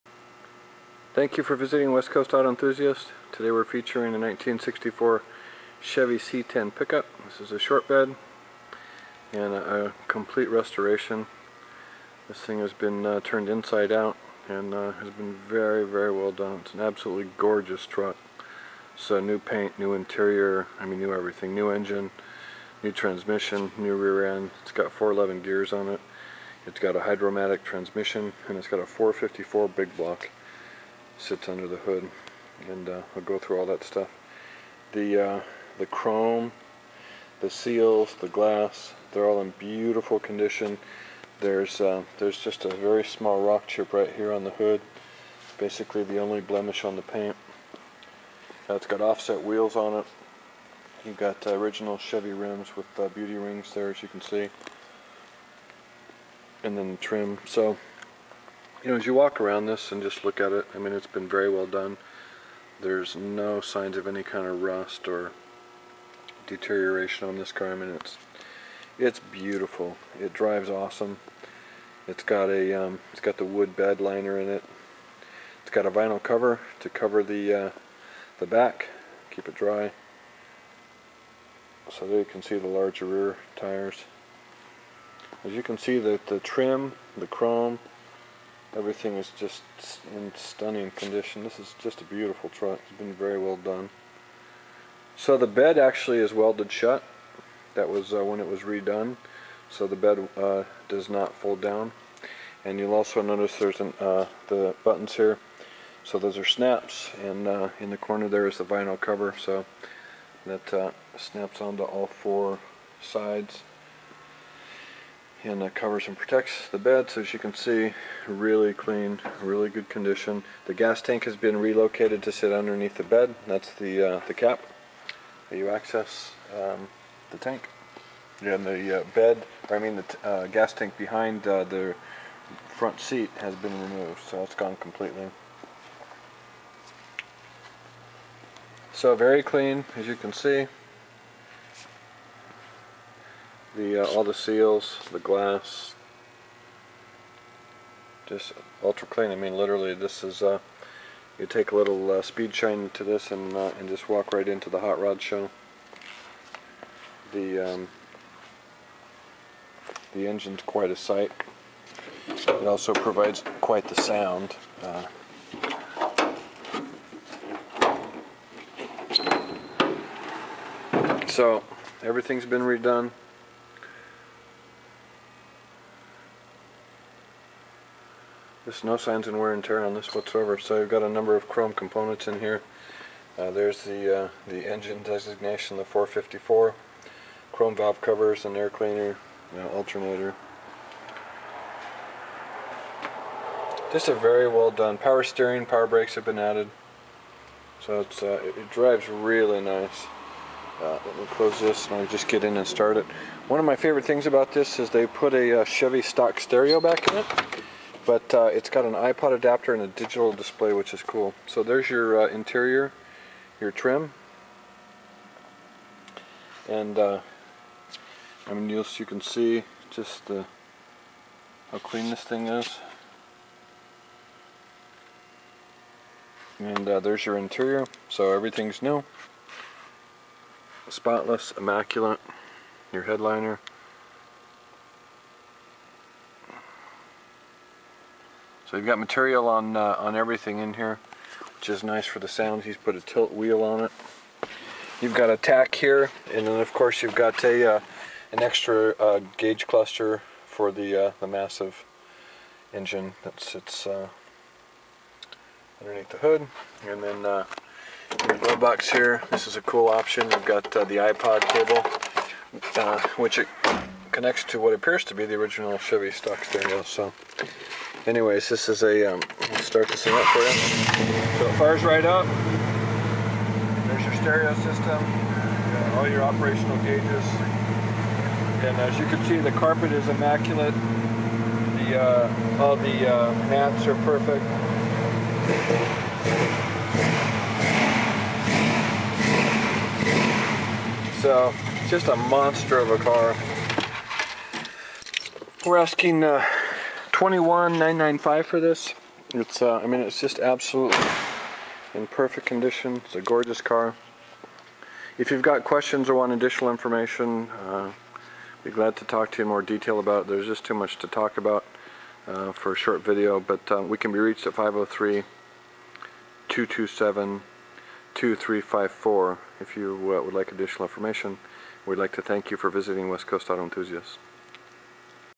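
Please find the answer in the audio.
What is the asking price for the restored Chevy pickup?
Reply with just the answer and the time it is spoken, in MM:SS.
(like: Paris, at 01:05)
$21,995, at 04:57.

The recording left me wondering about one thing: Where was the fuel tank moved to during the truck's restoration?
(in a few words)
Underneath the bed.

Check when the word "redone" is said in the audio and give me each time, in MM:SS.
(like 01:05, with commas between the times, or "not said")
01:38, 02:52.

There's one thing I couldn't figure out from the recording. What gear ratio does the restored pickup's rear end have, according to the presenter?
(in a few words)
4.11.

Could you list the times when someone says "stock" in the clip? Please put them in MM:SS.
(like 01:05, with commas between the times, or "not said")
03:26, 04:26.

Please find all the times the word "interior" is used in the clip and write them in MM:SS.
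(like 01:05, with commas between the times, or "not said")
00:19, 03:32, 03:47.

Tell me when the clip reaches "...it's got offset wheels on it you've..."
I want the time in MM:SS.
00:48.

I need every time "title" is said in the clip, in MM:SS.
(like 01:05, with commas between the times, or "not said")
not said.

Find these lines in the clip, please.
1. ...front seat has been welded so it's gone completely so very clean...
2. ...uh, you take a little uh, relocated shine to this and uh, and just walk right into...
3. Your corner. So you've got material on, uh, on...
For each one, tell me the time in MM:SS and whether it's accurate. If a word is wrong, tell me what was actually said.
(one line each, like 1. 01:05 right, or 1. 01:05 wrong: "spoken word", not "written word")
1. 02:12 wrong: "removed", not "welded"
2. 02:30 wrong: "speed", not "relocated"
3. 03:52 wrong: "headliner", not "corner".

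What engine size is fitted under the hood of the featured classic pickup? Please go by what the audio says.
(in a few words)
454.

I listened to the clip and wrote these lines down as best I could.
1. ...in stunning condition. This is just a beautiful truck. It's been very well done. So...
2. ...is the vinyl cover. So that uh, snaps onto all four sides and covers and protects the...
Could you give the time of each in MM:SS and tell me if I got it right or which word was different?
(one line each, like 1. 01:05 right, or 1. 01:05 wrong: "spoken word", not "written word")
1. 01:30 right
2. 01:48 right.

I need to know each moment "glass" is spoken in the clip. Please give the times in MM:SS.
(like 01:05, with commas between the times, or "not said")
00:38, 02:25.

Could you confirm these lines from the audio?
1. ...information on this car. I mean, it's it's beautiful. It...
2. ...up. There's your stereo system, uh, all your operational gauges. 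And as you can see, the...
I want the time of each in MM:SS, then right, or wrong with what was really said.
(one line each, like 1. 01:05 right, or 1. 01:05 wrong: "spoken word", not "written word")
1. 01:06 wrong: "deterioration", not "information"
2. 04:32 right.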